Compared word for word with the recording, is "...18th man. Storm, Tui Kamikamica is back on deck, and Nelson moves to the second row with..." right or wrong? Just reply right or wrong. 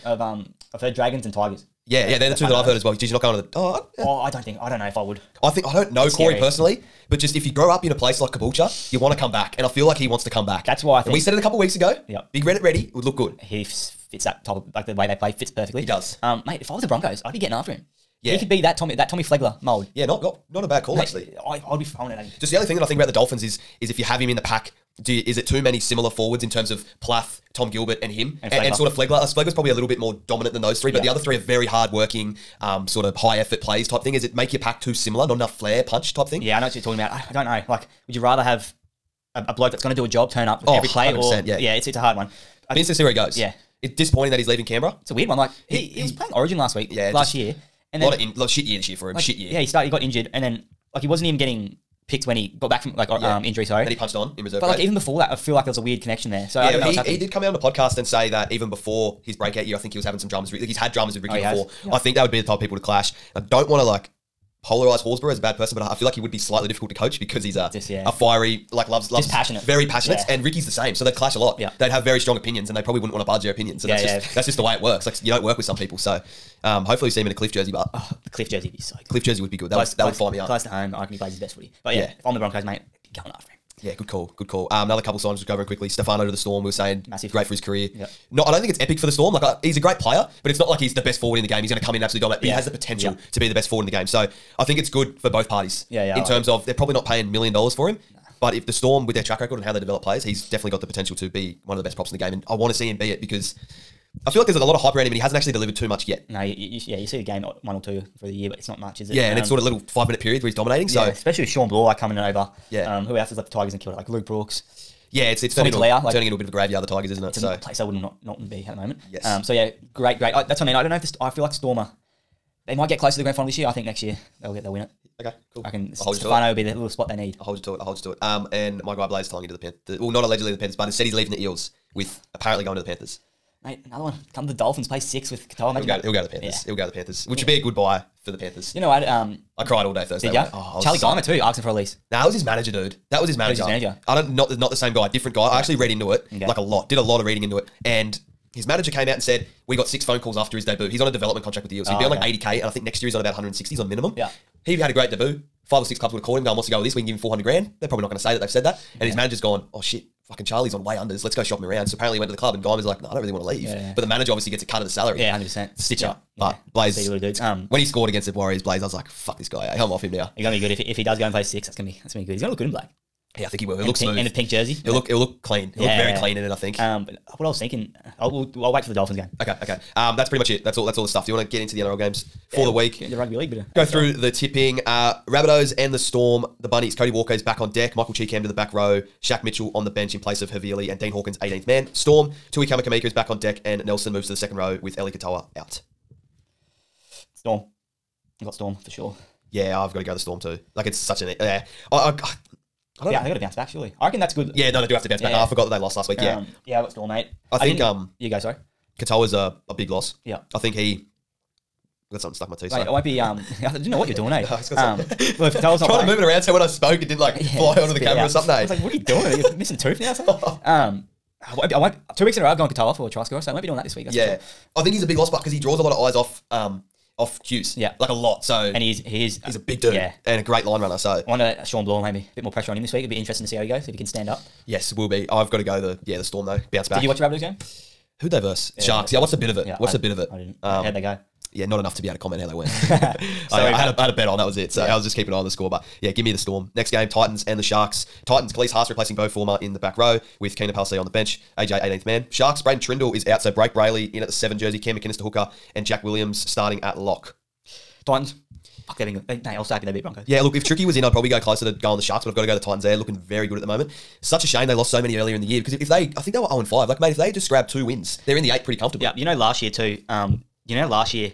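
right.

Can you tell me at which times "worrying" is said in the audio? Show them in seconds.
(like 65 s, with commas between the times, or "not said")
not said.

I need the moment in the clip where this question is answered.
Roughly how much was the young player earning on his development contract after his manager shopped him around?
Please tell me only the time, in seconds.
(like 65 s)
152 s.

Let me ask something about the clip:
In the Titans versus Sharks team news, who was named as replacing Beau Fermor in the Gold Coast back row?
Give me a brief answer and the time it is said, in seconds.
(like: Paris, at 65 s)
Klese Haas, at 248 s.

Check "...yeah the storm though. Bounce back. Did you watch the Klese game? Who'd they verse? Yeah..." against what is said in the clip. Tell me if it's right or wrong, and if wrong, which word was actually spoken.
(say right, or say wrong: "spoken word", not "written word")
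wrong: "Rabbitohs", not "Klese".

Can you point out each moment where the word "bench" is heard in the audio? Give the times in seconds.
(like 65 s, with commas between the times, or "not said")
189 s, 251 s.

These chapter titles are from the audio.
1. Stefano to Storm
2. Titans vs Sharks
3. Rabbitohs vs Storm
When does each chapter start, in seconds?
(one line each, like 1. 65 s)
1. 84 s
2. 245 s
3. 184 s.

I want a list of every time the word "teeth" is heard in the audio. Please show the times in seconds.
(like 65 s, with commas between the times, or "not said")
212 s.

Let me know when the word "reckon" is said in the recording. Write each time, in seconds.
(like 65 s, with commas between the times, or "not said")
81 s, 204 s.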